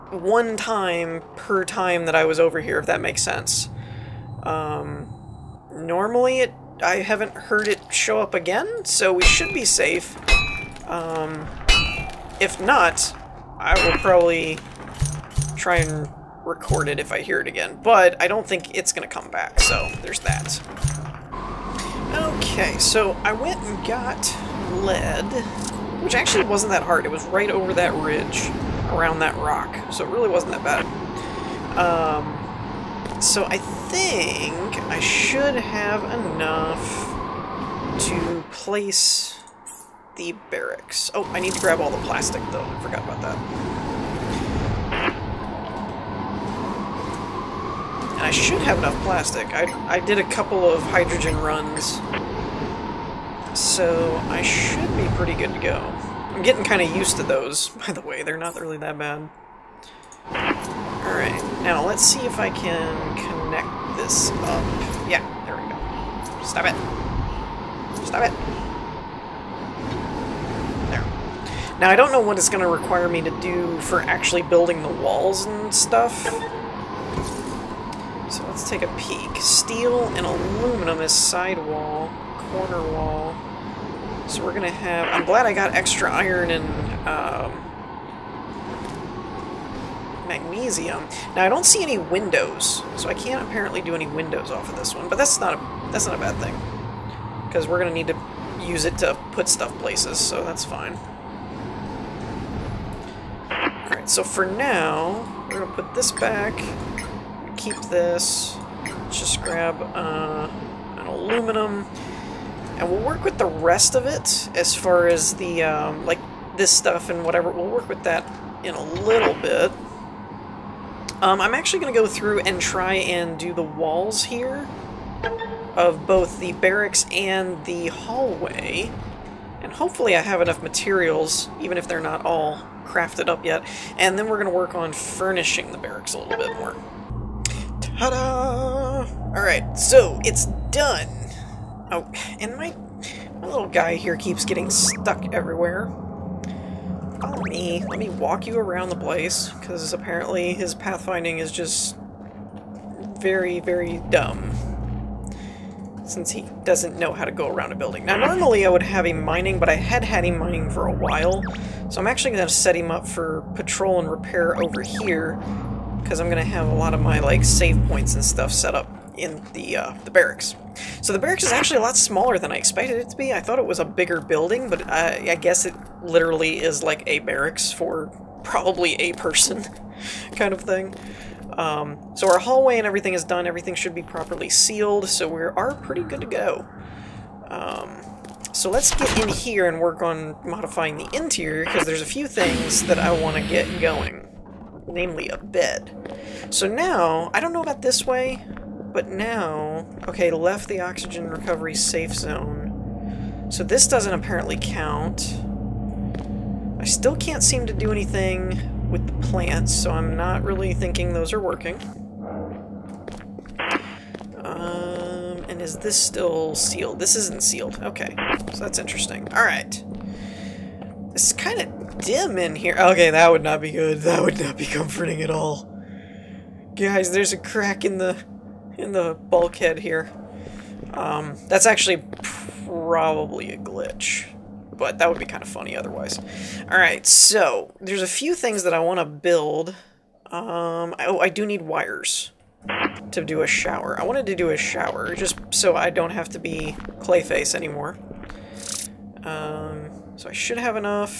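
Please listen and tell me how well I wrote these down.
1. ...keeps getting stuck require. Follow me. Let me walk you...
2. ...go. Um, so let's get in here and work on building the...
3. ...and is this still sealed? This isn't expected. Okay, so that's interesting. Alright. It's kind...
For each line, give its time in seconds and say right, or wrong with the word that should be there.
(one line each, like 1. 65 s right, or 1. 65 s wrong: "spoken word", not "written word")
1. 144 s wrong: "everywhere", not "require"
2. 186 s wrong: "modifying", not "building"
3. 215 s wrong: "sealed", not "expected".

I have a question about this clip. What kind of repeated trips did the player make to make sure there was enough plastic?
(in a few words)
hydrogen runs.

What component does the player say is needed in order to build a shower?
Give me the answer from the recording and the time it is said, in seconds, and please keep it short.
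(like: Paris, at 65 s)
wires, at 241 s.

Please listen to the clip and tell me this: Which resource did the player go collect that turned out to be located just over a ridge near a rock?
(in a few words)
lead.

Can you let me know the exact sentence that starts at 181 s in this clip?
Um, so our hallway and everything is done.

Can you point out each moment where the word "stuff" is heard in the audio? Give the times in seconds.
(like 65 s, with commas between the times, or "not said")
75 s, 99 s, 116 s, 168 s.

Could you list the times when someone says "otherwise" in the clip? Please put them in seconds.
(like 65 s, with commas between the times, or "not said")
235 s.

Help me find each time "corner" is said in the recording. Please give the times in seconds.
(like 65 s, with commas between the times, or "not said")
82 s.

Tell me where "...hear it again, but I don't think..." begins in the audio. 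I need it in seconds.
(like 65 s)
17 s.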